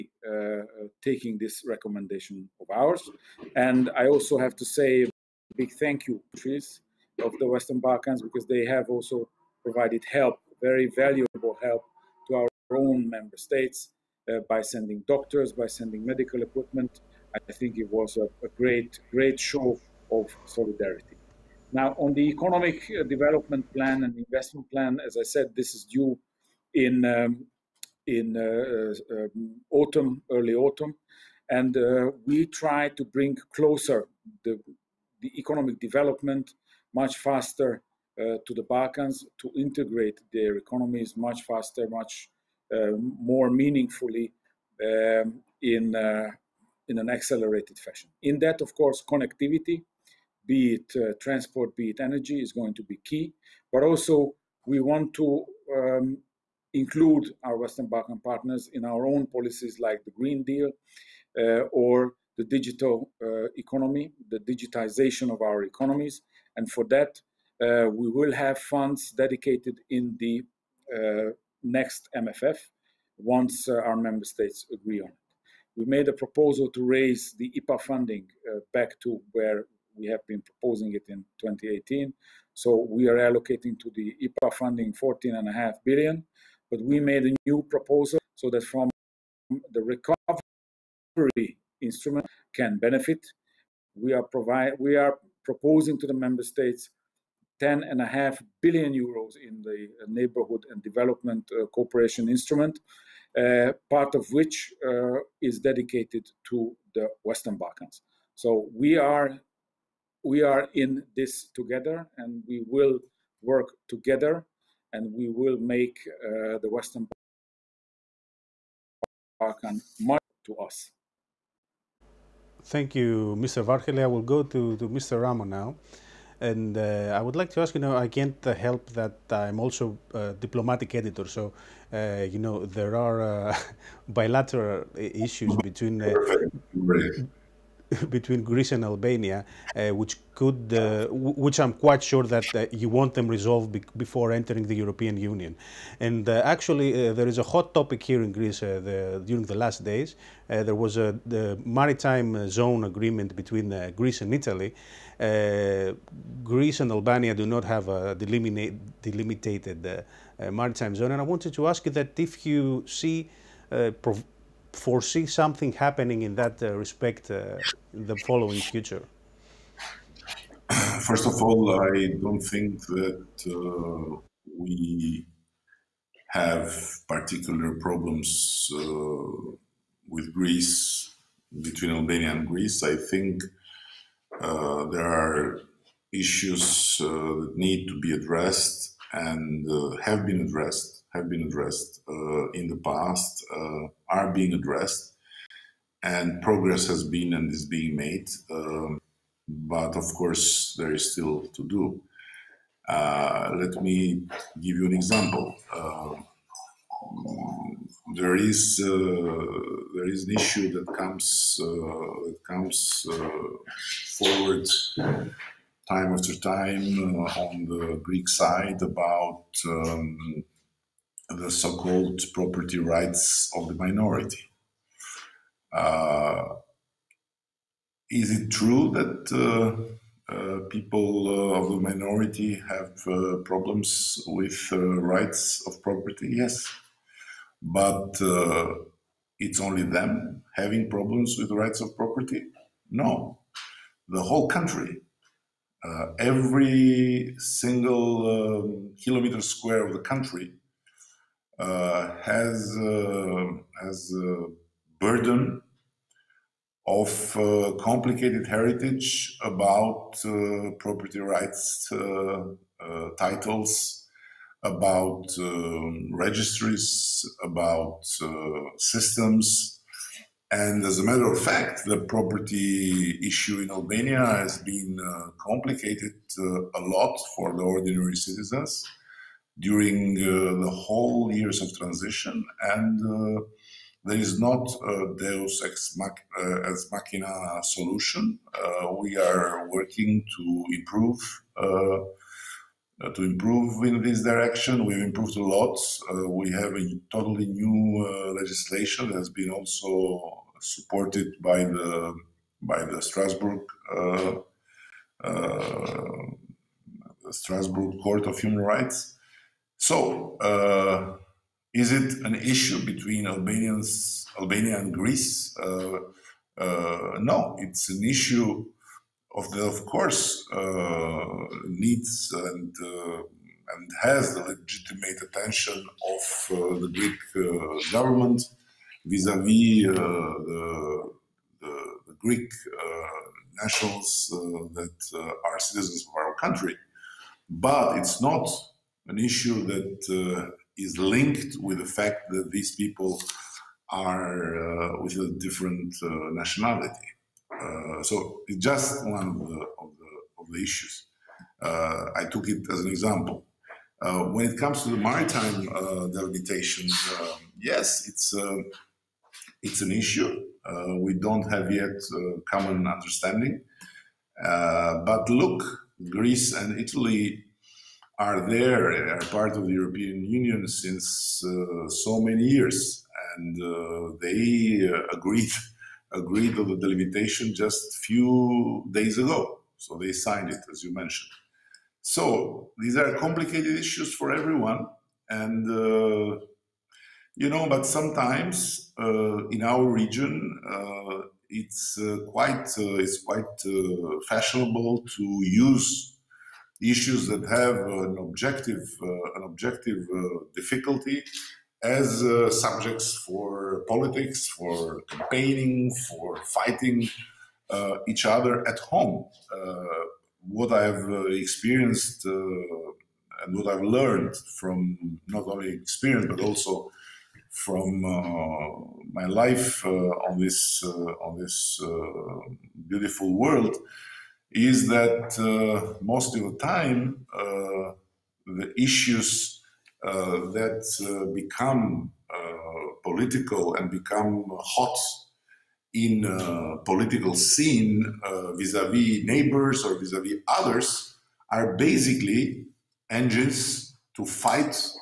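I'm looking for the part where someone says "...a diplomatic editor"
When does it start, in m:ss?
2:10.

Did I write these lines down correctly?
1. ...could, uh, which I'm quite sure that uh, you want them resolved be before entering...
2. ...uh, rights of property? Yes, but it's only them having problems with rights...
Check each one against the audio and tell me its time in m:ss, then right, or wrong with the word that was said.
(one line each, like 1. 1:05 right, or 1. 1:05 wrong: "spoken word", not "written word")
1. 2:20 right
2. 3:54 right.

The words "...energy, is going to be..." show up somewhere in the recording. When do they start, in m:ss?
0:52.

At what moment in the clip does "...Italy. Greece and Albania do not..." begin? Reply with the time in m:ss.
2:34.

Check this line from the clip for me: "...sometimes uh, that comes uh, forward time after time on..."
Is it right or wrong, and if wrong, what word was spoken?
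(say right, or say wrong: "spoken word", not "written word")
wrong: "comes", not "sometimes".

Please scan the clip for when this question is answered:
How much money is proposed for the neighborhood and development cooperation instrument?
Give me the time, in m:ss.
1:37.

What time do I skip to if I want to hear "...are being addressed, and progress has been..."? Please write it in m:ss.
3:14.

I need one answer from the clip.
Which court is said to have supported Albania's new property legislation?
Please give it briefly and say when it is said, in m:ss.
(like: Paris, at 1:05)
Strasbourg Court of Human Rights, at 5:07.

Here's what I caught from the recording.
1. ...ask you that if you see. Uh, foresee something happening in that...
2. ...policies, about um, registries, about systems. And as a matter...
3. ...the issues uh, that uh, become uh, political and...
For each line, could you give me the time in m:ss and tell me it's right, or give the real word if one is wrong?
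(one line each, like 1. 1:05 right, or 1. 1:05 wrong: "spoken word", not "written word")
1. 2:41 right
2. 4:23 wrong: "titles", not "policies"
3. 7:08 right.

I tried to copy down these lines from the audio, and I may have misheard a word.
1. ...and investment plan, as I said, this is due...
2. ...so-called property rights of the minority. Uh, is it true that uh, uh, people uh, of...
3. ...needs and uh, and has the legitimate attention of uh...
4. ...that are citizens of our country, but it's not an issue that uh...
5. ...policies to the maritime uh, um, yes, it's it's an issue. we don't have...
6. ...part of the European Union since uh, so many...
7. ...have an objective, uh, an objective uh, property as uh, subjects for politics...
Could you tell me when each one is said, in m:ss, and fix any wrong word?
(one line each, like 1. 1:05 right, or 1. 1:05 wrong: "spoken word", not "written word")
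1. 0:24 right
2. 3:41 right
3. 5:21 right
4. 5:34 right
5. 5:54 wrong: "comes", not "policies"
6. 6:09 right
7. 6:37 wrong: "difficulty", not "property".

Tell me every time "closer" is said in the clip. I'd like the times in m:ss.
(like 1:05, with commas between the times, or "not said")
0:33.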